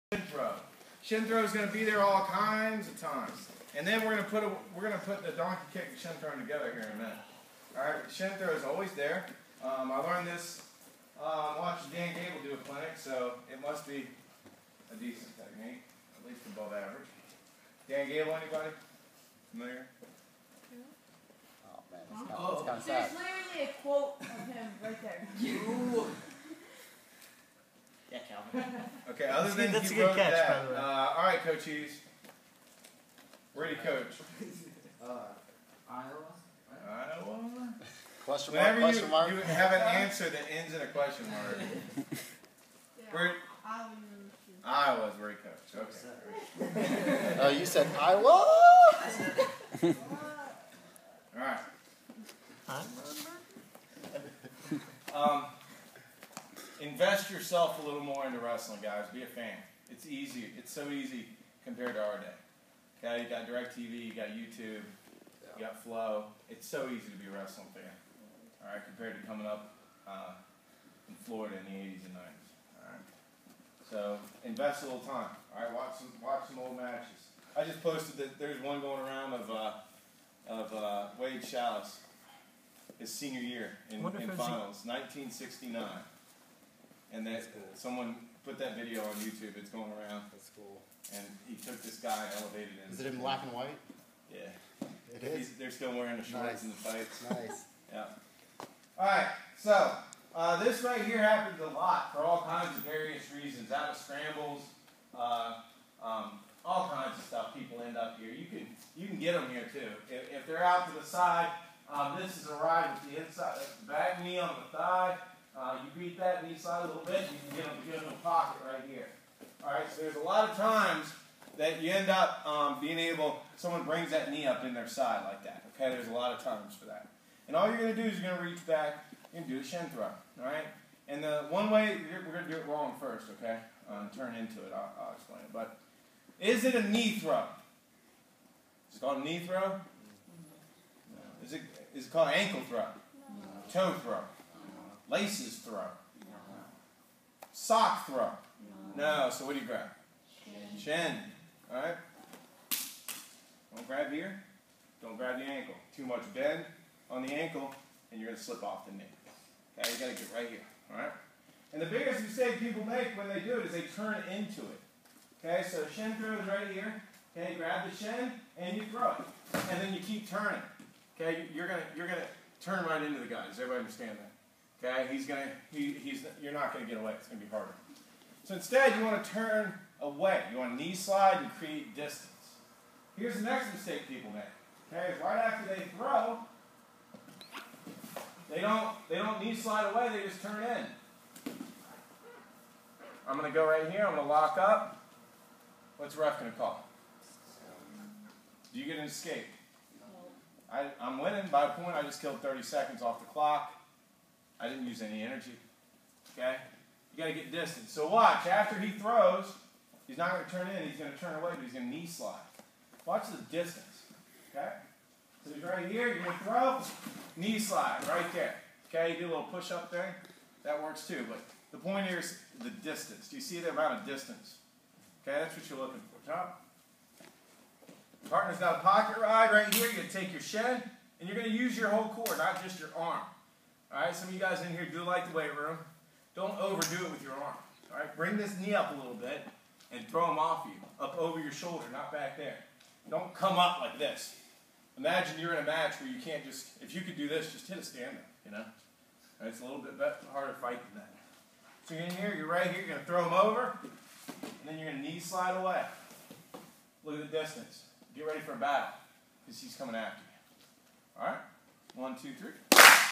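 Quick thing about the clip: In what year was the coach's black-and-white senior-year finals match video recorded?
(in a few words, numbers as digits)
1969.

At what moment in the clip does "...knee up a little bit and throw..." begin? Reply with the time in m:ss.
3:58.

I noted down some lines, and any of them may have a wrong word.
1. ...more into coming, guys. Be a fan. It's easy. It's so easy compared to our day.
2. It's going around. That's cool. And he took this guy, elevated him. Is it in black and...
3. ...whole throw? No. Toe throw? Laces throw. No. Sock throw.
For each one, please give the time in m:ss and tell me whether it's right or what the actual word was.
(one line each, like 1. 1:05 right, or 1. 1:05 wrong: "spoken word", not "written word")
1. 0:58 wrong: "wrestling", not "coming"
2. 1:29 right
3. 2:22 wrong: "ankle", not "whole".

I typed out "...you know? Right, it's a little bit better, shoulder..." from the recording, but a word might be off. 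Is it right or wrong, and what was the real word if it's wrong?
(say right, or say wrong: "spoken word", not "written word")
wrong: "harder", not "shoulder".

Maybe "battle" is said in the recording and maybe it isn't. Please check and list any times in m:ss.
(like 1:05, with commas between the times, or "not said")
4:18.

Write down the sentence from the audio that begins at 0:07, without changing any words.
All right, shin throw is always there.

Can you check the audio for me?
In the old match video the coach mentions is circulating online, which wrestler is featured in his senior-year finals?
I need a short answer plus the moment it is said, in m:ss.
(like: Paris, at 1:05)
Wade Schalles, at 1:21.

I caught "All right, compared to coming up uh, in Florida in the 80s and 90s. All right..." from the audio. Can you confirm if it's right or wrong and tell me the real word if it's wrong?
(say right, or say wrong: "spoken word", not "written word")
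right.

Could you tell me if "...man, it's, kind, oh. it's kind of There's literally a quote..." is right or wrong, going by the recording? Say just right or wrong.
right.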